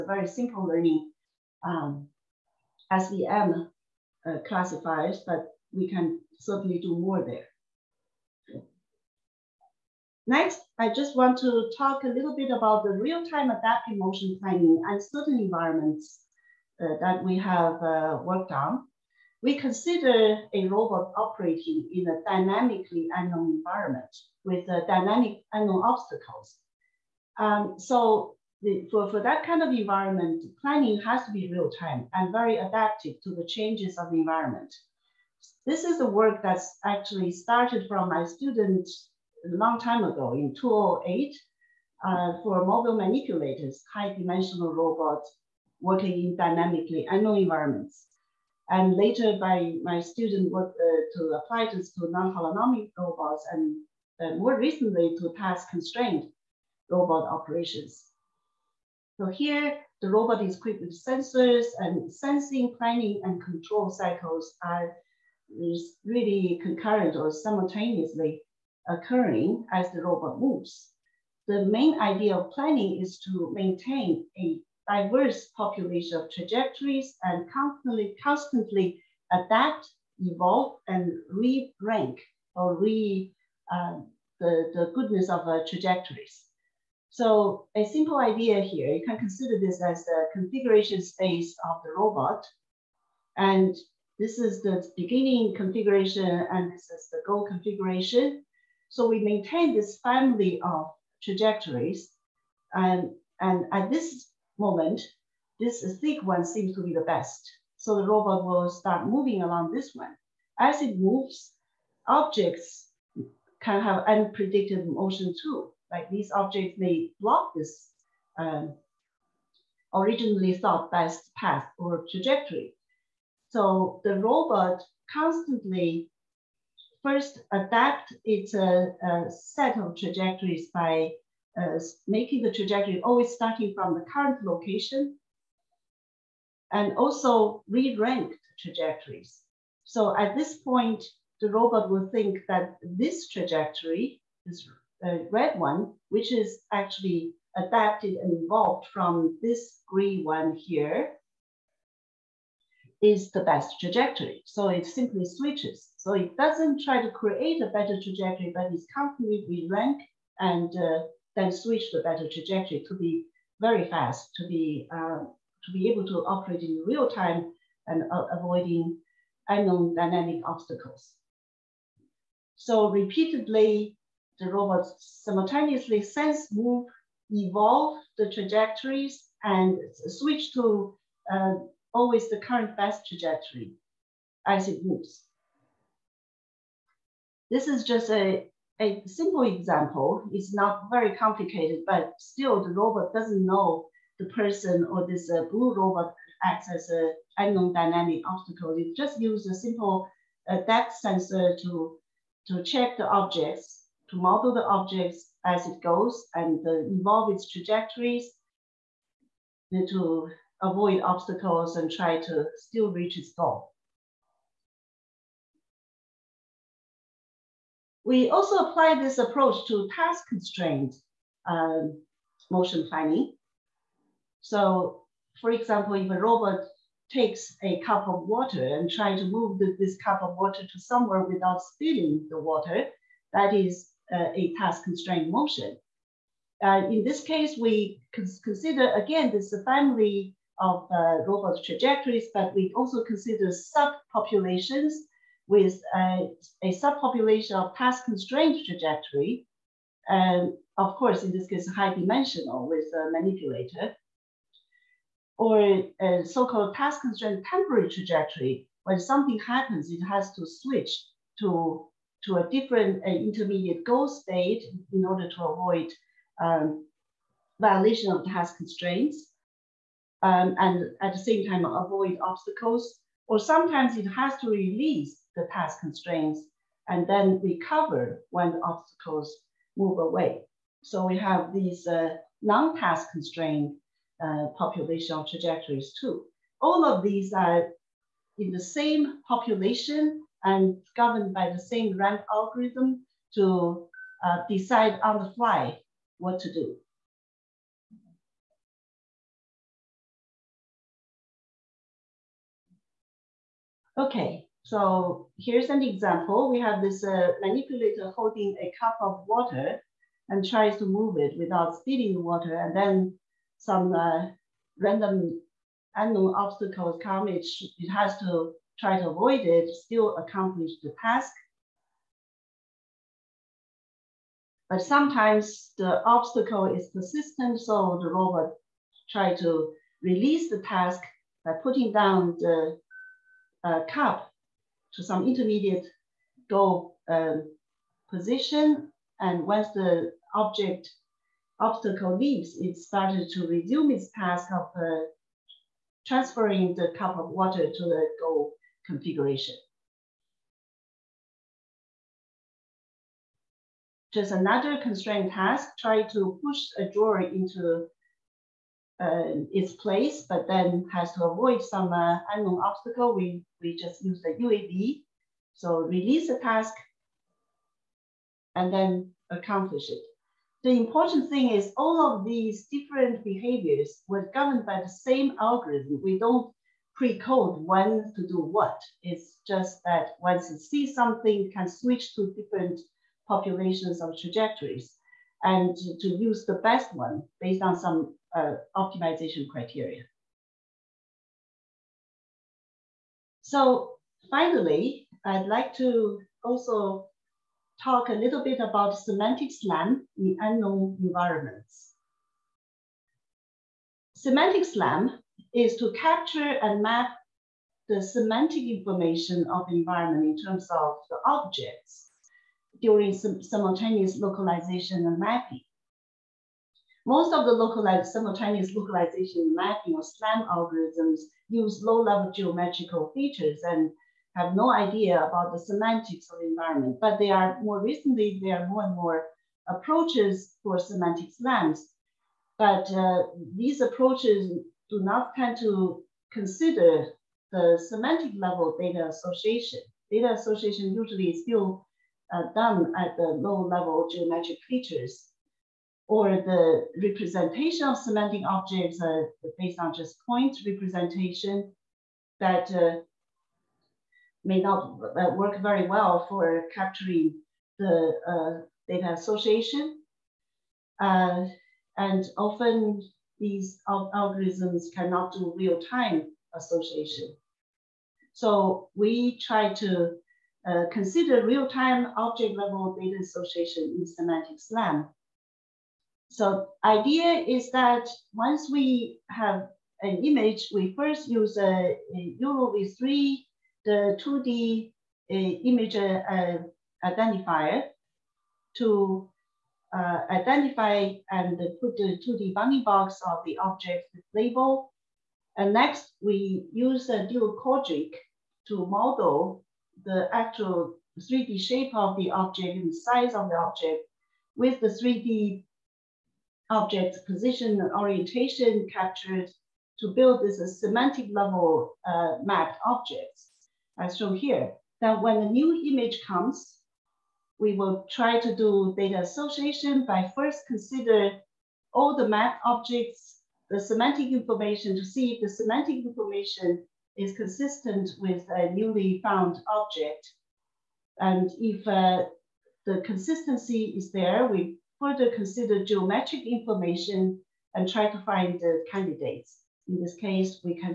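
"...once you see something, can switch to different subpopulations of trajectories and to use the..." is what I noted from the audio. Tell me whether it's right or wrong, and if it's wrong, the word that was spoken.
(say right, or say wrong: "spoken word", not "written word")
wrong: "populations", not "subpopulations".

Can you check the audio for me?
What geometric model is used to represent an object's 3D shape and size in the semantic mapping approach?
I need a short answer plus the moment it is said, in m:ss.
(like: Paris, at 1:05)
dual quadric, at 8:17.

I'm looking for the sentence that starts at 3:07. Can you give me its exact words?
This is just a, a simple example.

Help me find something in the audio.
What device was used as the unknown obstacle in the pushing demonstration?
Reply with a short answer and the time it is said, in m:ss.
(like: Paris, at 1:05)
UAV, at 6:04.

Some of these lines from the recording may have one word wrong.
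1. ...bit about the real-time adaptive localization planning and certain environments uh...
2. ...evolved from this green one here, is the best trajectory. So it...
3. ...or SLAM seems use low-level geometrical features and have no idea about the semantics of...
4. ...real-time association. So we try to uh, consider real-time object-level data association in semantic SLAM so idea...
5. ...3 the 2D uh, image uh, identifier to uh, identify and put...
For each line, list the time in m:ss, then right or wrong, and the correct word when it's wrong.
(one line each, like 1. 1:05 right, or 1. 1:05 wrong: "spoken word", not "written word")
1. 0:12 wrong: "motion", not "localization"
2. 2:28 right
3. 6:59 wrong: "algorithms", not "seems"
4. 7:45 right
5. 8:02 right.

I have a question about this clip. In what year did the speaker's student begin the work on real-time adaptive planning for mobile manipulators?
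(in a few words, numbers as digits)
2008.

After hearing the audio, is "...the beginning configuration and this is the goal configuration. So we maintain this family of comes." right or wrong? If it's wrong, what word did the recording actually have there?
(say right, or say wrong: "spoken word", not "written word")
wrong: "trajectories", not "comes".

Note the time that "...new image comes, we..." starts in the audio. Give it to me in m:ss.
8:35.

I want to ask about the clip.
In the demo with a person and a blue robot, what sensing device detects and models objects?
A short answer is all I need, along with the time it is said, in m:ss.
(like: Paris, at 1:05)
depth sensor, at 3:20.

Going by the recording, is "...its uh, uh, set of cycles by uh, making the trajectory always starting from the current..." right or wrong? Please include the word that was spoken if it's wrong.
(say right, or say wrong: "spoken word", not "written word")
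wrong: "trajectories", not "cycles".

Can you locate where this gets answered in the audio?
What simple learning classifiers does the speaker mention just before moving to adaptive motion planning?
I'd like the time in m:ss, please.
0:02.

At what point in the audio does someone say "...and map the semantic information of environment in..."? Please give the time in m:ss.
6:46.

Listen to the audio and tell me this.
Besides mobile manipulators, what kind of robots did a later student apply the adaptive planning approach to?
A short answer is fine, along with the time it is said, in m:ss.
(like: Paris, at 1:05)
non-holonomic robots, at 0:52.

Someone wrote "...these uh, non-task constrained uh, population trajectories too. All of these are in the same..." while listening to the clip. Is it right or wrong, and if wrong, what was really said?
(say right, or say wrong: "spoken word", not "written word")
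right.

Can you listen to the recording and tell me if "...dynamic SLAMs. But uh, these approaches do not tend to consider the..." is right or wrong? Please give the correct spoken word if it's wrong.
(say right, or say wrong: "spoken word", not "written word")
wrong: "semantic", not "dynamic".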